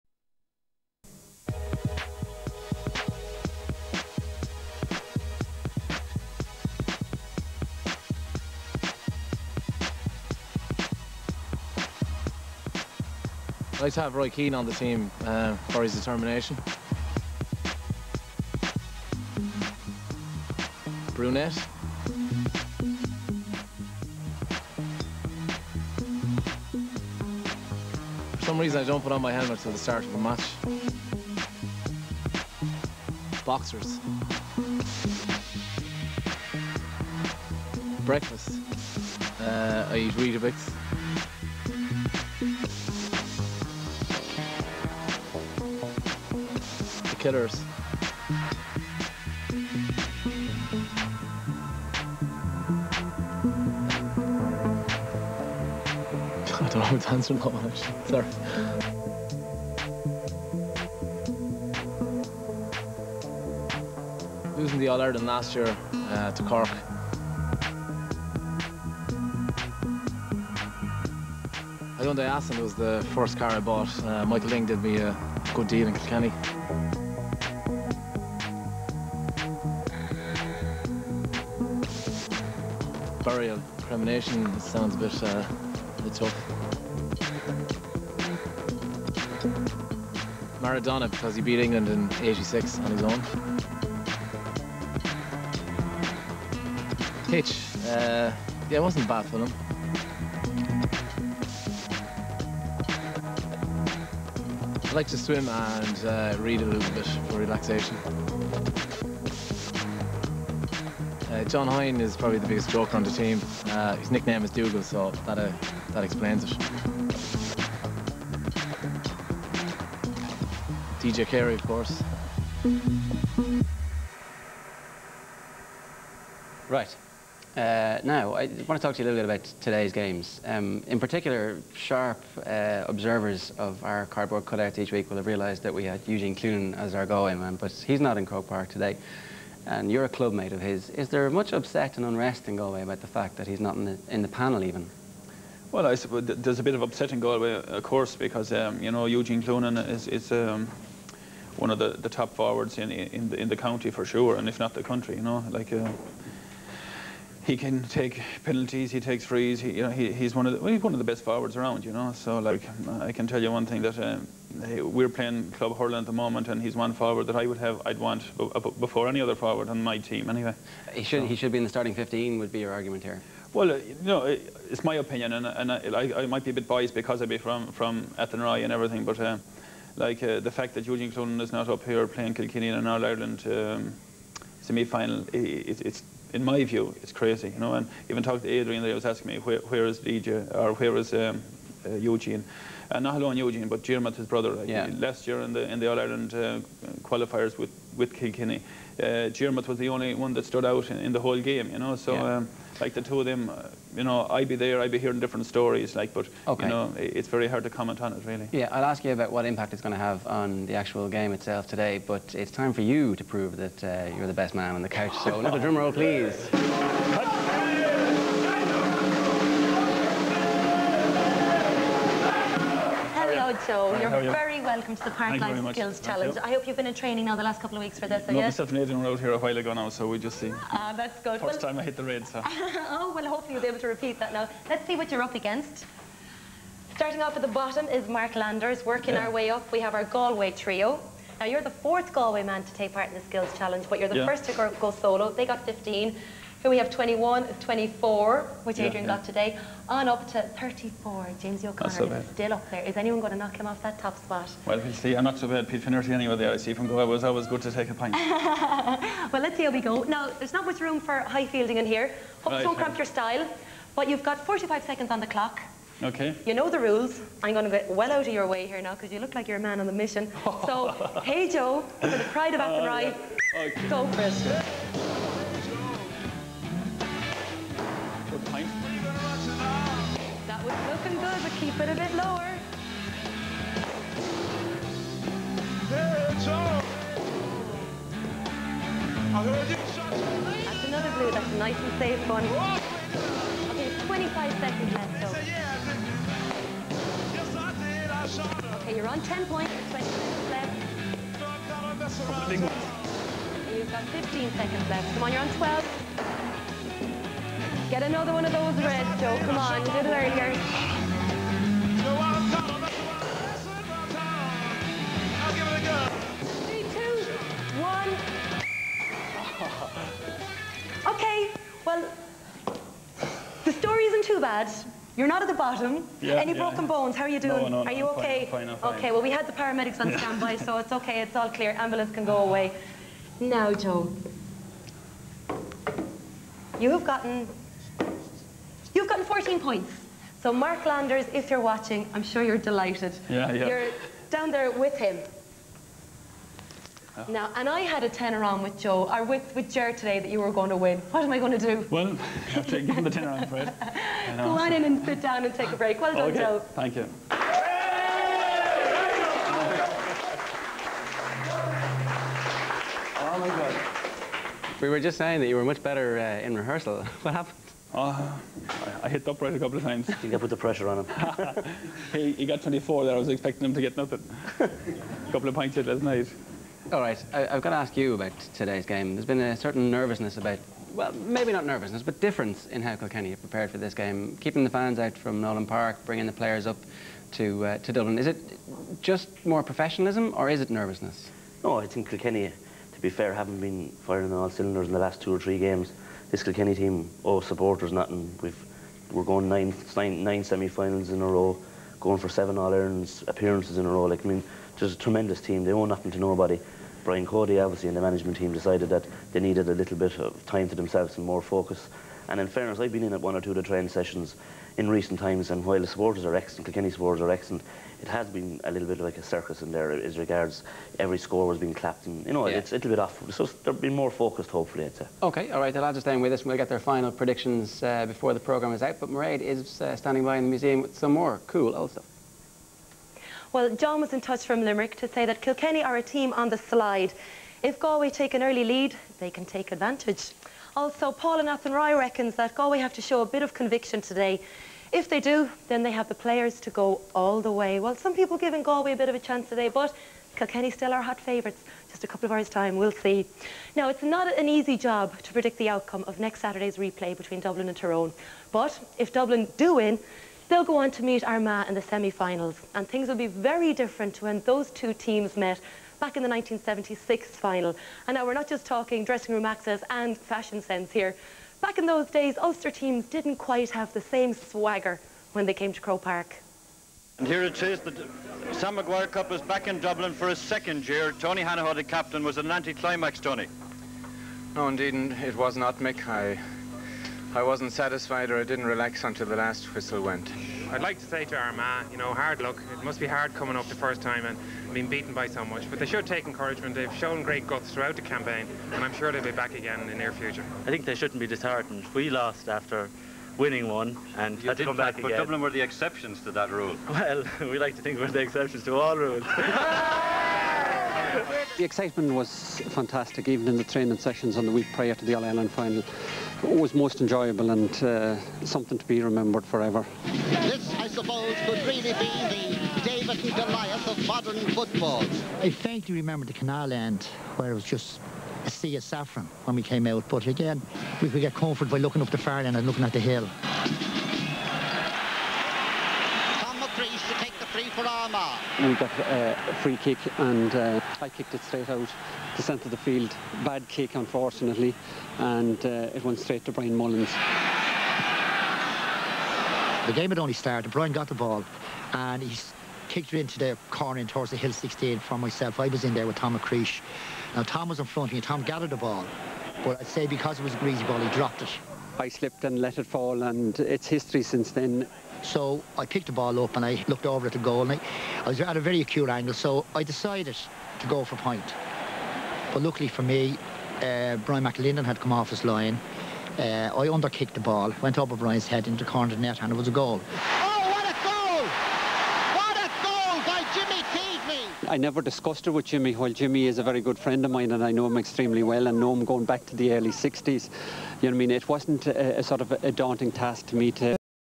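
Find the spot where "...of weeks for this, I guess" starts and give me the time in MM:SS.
03:47.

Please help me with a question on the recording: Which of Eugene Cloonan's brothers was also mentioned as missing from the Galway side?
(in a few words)
Dermot.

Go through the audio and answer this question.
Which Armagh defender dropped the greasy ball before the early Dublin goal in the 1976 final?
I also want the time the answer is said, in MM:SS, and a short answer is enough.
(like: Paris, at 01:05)
Tom McCreesh, at 09:16.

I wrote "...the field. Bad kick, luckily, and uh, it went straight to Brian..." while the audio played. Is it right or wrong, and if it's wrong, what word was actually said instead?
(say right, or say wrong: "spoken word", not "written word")
wrong: "unfortunately", not "luckily".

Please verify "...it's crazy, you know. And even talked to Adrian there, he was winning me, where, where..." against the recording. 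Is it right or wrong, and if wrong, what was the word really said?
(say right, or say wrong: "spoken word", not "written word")
wrong: "asking", not "winning".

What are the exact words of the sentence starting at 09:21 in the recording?
I slipped and let it fall, and it's history since then.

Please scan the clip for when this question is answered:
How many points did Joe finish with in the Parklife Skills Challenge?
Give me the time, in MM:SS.
05:39.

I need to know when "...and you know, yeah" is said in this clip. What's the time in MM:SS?
07:02.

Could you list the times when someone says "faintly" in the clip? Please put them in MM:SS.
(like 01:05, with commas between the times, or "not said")
08:45.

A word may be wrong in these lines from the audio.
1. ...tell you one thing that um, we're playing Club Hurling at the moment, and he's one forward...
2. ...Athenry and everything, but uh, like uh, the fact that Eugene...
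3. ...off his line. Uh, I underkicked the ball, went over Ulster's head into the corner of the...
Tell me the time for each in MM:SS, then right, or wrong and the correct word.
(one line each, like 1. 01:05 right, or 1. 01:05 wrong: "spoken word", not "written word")
1. 02:43 right
2. 02:58 right
3. 09:35 wrong: "Brian", not "Ulster".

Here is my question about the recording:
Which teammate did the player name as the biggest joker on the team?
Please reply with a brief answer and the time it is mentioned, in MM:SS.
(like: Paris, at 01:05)
John Hoyne, at 01:51.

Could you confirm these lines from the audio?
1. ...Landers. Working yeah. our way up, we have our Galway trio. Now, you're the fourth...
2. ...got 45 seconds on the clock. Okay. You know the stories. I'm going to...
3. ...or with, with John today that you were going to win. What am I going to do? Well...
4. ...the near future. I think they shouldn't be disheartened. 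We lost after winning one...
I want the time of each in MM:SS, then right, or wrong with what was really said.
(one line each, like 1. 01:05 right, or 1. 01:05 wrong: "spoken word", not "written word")
1. 03:58 right
2. 04:24 wrong: "rules", not "stories"
3. 05:49 wrong: "Jer", not "John"
4. 08:19 right.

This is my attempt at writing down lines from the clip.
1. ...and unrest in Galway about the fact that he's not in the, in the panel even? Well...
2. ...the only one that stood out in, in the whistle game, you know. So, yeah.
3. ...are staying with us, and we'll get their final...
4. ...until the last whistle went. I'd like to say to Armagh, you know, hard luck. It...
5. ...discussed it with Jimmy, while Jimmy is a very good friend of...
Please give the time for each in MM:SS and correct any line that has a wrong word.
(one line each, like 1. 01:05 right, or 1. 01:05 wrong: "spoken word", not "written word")
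1. 02:21 right
2. 03:19 wrong: "whole", not "whistle"
3. 07:05 right
4. 08:09 right
5. 09:45 right.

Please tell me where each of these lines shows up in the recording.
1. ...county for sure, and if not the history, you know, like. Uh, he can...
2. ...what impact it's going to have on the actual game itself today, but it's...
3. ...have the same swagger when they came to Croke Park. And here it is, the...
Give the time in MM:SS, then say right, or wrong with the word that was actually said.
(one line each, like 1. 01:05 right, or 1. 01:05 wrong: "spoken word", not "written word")
1. 02:33 wrong: "country", not "history"
2. 03:29 right
3. 07:53 right.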